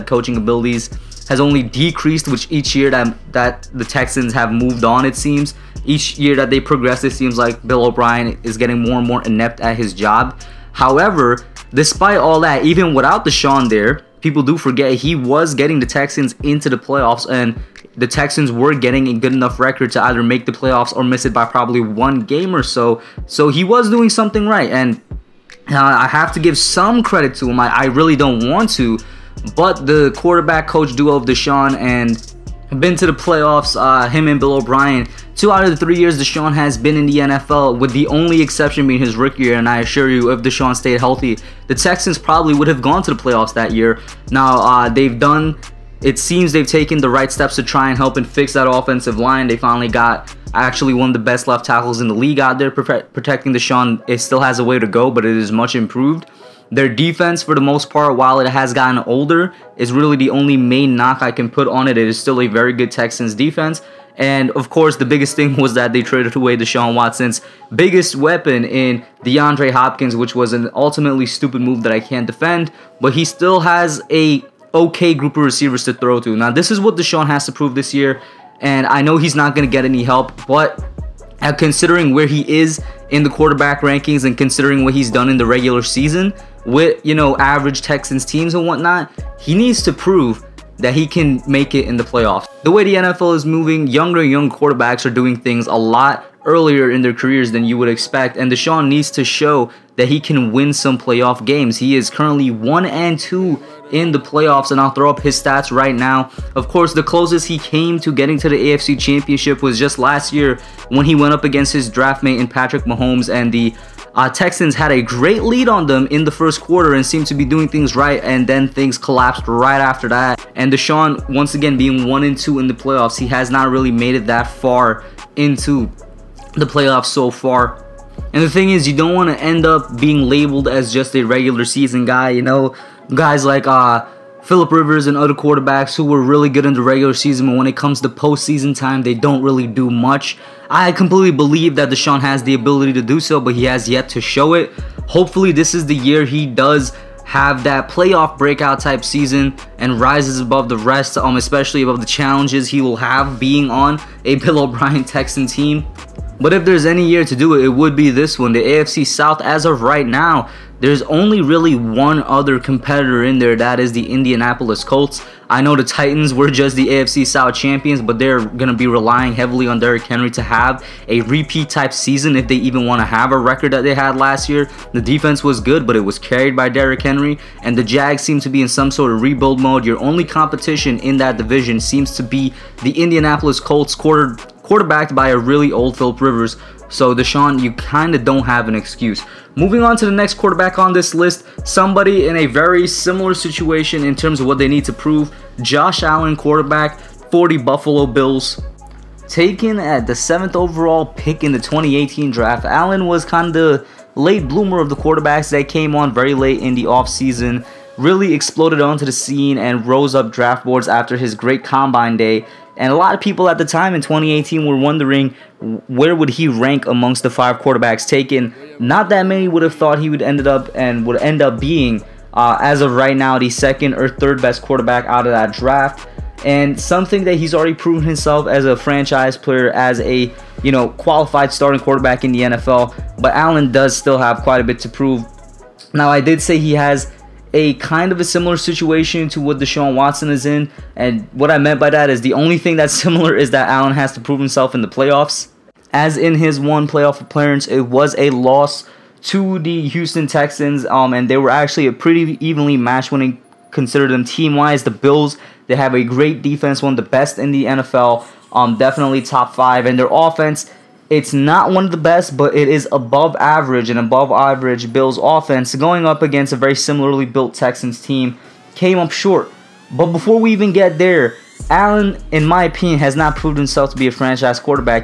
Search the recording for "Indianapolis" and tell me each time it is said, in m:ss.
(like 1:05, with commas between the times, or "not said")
2:44, 3:03.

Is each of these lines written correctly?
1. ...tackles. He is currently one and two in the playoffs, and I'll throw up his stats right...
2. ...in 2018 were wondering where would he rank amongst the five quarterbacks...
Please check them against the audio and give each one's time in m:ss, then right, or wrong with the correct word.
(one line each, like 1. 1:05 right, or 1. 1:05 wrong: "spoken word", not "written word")
1. 1:41 wrong: "games", not "tackles"
2. 3:33 right.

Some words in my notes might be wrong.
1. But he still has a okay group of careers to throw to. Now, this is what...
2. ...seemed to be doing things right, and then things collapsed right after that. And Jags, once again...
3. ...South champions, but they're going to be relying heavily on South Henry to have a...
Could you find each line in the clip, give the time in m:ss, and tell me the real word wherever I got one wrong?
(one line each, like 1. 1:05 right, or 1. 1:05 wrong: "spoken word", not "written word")
1. 1:12 wrong: "receivers", not "careers"
2. 1:57 wrong: "Deshaun", not "Jags"
3. 2:47 wrong: "Derrick", not "South".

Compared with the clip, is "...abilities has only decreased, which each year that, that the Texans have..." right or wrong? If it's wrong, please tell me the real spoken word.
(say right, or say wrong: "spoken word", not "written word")
right.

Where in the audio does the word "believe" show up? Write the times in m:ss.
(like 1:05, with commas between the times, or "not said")
2:21.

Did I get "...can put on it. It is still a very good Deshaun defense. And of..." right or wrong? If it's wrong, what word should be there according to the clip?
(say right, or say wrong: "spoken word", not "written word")
wrong: "Texans", not "Deshaun".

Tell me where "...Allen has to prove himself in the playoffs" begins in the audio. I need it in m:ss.
4:03.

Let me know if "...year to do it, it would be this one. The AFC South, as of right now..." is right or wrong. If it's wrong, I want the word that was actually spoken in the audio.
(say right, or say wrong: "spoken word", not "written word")
right.